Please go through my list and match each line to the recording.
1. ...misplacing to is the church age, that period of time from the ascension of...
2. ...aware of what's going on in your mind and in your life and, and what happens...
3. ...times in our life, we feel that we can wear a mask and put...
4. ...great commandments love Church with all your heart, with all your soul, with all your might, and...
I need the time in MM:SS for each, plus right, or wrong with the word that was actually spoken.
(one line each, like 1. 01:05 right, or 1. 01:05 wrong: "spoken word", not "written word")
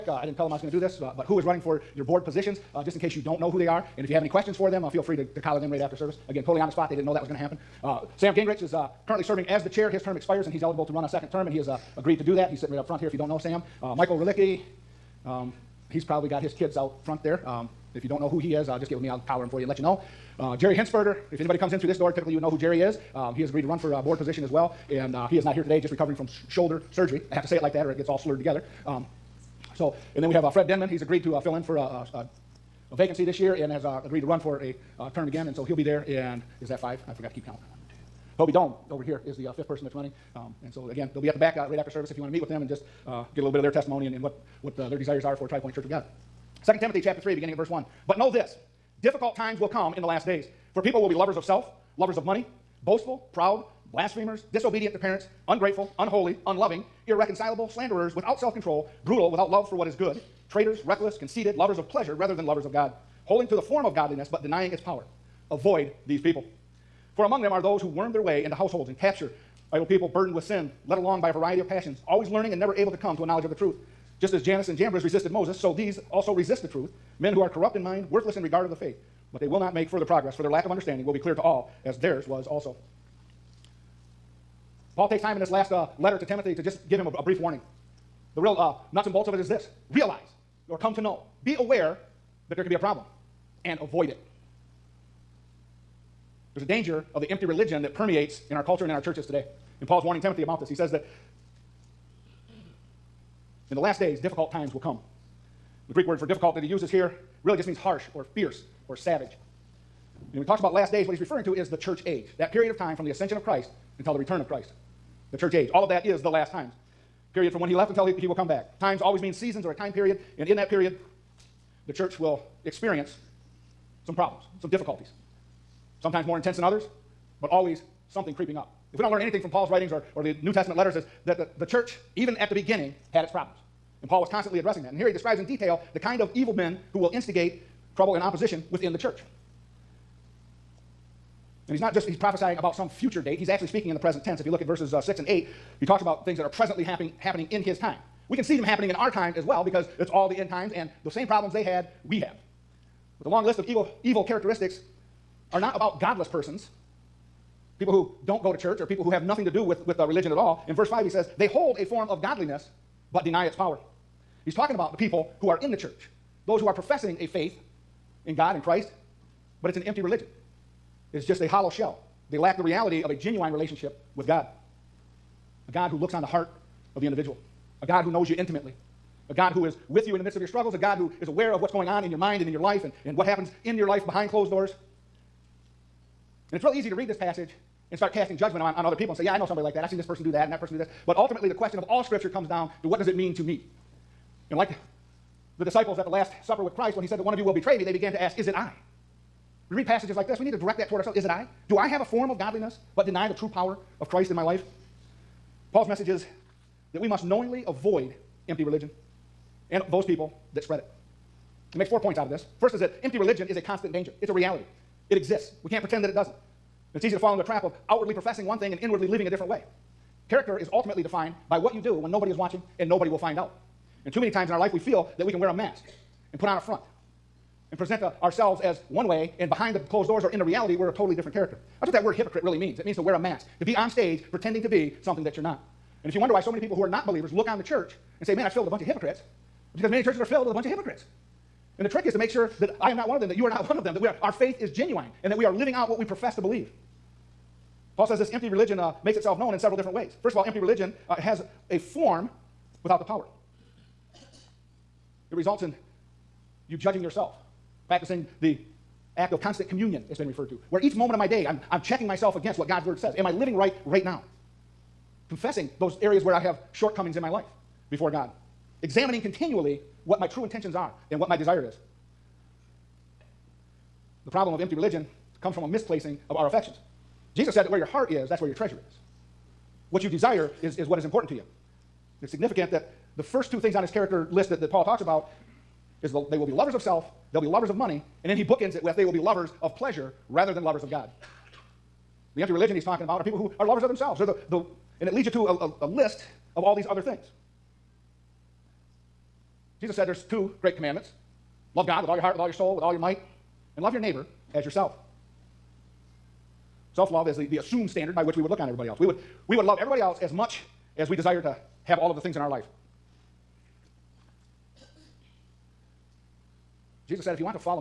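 1. 01:51 wrong: "referring", not "misplacing"
2. 03:01 right
3. 03:44 right
4. 05:00 wrong: "God", not "Church".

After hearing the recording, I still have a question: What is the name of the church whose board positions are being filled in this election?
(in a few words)
TriPoint Church of God.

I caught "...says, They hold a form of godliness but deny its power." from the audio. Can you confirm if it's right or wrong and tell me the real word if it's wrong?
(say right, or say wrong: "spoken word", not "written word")
right.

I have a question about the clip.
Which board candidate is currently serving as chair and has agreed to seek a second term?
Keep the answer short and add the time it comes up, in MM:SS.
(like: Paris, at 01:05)
Sam Gingrich, at 00:08.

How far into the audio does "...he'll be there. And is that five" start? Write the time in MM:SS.
00:35.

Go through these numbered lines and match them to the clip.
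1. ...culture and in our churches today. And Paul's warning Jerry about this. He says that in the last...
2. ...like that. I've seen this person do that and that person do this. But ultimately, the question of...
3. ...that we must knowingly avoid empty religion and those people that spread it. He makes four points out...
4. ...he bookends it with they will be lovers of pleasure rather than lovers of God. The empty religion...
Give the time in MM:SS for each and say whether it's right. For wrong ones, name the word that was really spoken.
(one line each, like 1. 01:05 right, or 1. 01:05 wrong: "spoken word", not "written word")
1. 01:38 wrong: "Timothy", not "Jerry"
2. 03:09 right
3. 03:26 right
4. 04:48 right.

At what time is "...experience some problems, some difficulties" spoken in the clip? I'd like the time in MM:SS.
02:02.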